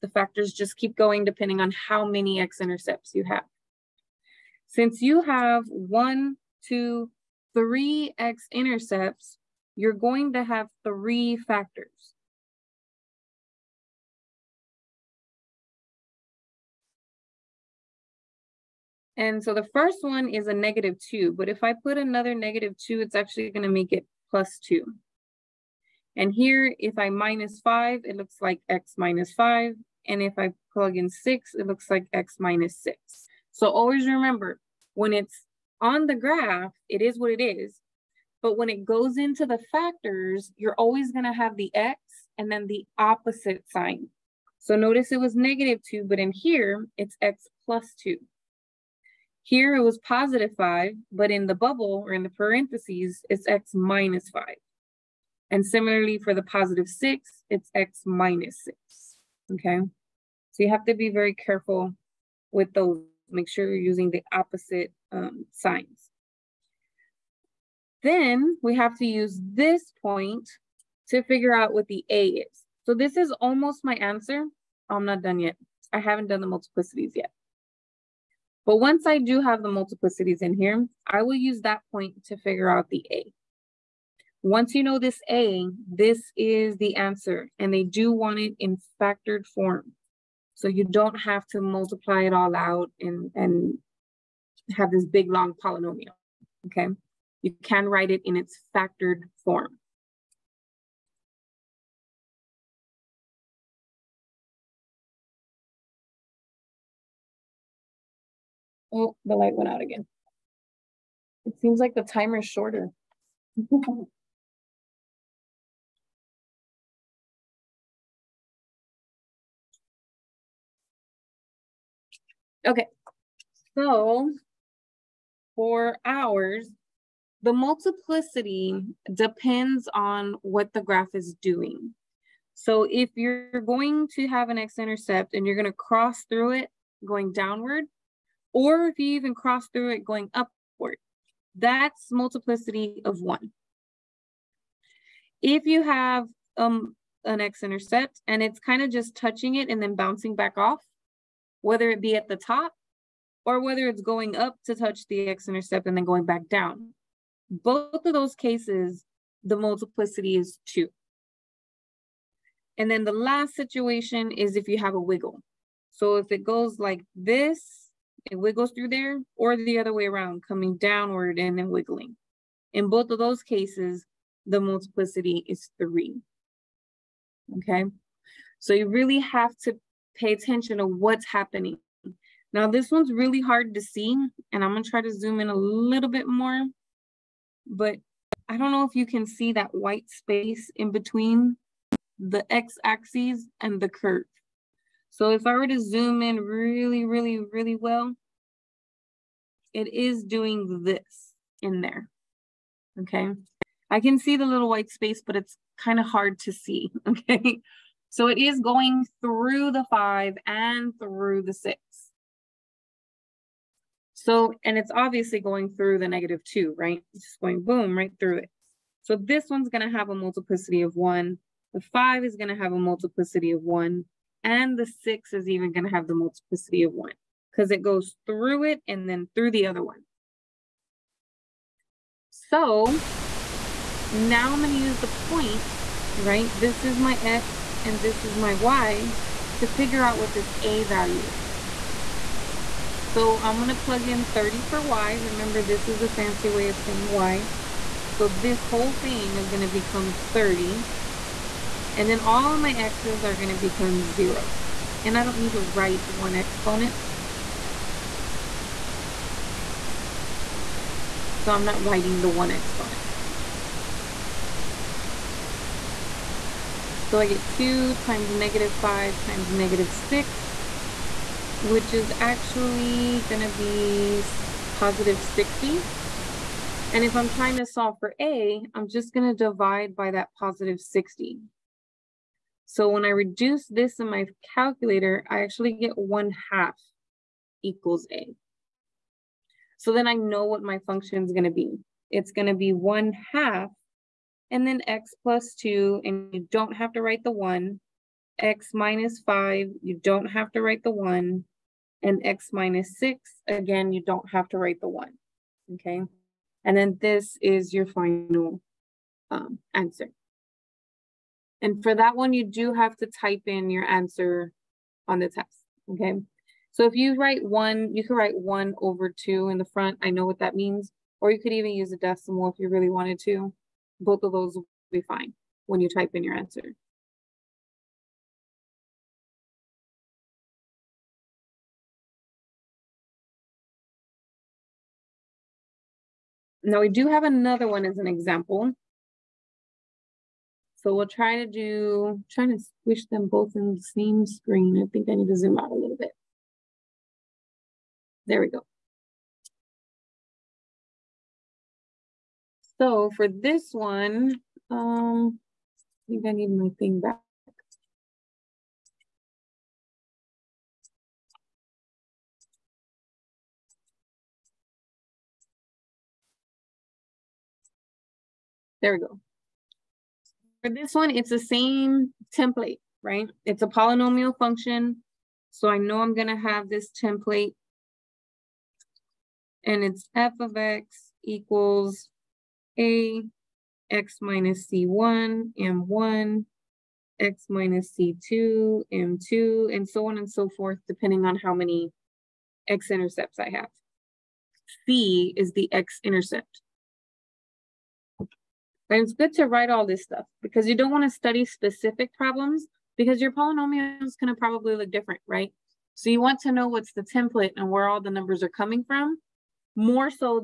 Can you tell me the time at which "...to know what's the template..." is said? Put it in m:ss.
6:46.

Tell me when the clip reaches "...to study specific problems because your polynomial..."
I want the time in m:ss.
6:41.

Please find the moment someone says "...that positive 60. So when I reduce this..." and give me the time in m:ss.
4:40.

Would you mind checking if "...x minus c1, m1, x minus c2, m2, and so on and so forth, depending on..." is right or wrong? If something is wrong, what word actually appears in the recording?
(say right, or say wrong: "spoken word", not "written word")
right.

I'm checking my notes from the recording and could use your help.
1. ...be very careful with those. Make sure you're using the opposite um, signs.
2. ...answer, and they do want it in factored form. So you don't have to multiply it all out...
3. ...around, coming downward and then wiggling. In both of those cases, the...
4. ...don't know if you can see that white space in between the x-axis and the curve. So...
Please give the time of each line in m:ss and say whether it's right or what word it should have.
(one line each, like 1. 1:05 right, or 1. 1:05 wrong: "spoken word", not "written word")
1. 1:00 right
2. 1:26 right
3. 2:50 right
4. 3:08 right.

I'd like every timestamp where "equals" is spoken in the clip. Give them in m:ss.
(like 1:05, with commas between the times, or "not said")
4:47, 6:21.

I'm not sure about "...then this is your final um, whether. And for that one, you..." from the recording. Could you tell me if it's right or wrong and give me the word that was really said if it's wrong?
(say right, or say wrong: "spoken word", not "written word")
wrong: "answer", not "whether".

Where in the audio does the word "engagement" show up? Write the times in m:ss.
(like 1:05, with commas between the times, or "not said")
not said.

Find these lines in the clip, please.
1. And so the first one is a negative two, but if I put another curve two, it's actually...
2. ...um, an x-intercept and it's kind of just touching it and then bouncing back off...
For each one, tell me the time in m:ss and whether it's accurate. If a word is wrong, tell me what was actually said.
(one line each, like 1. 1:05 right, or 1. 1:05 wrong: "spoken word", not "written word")
1. 0:19 wrong: "negative", not "curve"
2. 2:26 right.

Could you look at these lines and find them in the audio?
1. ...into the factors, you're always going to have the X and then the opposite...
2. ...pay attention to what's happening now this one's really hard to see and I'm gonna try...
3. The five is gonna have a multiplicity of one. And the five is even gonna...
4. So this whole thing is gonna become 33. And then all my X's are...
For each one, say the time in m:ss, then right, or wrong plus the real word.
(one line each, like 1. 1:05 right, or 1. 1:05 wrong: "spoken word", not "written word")
1. 0:39 right
2. 3:00 right
3. 3:41 wrong: "six", not "five"
4. 4:08 wrong: "30", not "33".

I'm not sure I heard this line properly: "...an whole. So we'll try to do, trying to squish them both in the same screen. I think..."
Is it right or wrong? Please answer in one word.
wrong.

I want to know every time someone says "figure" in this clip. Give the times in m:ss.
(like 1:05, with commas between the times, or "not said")
1:11, 1:22, 3:59.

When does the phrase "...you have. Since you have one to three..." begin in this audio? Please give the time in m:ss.
0:03.